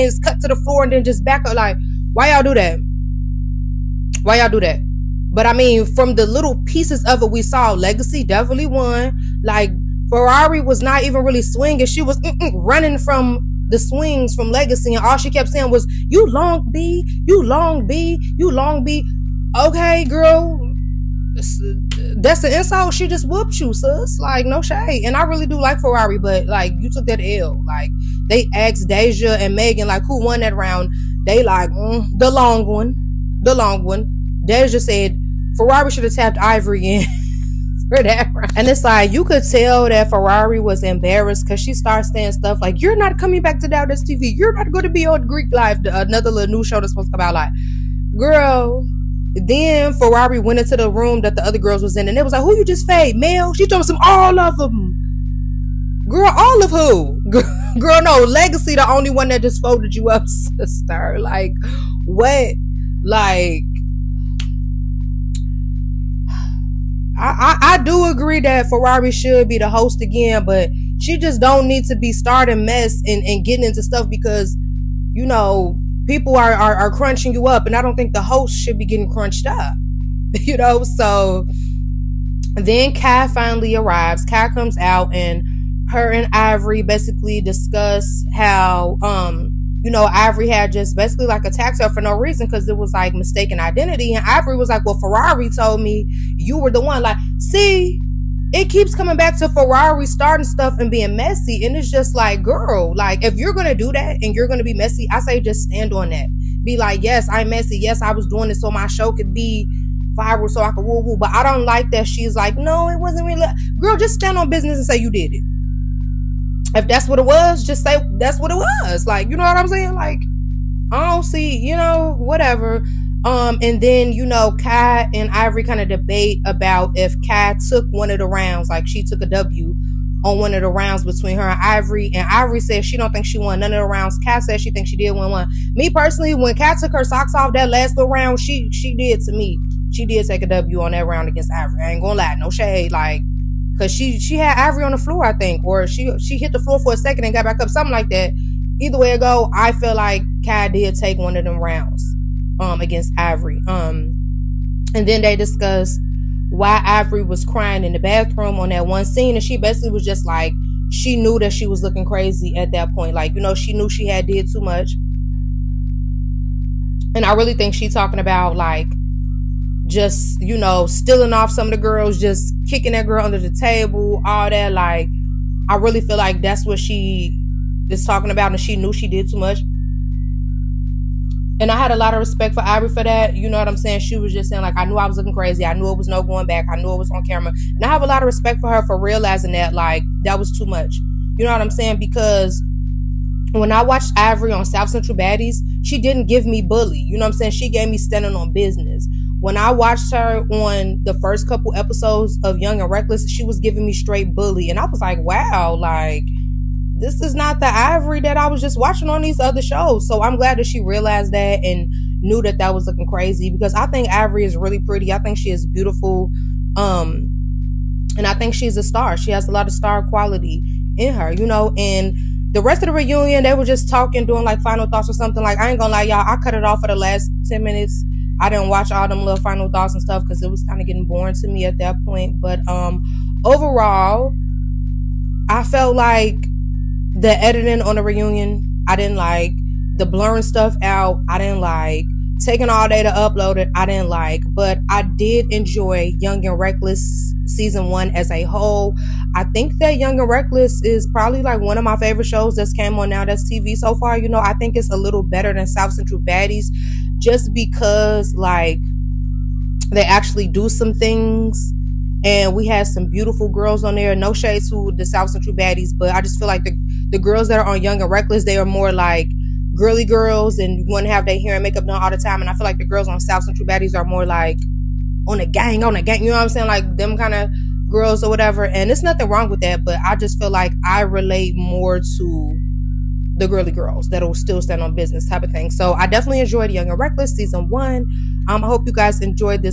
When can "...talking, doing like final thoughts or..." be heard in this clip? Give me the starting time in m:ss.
3:43.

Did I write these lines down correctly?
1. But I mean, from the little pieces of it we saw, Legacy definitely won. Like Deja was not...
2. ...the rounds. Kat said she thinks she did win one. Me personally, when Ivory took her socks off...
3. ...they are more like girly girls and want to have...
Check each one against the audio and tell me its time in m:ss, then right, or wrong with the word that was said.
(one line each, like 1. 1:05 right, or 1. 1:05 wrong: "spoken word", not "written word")
1. 0:05 wrong: "Ferrari", not "Deja"
2. 2:13 wrong: "Kat", not "Ivory"
3. 4:28 right.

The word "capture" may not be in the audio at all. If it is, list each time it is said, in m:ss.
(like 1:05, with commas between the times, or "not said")
not said.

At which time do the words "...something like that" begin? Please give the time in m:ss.
2:27.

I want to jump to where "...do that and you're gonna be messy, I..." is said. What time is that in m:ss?
1:43.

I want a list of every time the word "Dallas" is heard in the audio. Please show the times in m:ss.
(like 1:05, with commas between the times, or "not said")
0:43.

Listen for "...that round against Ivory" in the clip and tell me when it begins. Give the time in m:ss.
2:20.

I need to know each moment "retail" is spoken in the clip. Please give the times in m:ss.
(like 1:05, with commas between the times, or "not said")
not said.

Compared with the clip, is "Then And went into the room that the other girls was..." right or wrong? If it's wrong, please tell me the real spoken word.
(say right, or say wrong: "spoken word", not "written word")
wrong: "Ferrari", not "And".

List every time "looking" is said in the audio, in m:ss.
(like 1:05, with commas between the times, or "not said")
2:41, 3:05, 3:32.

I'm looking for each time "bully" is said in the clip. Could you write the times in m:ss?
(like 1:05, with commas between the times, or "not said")
3:16, 3:24.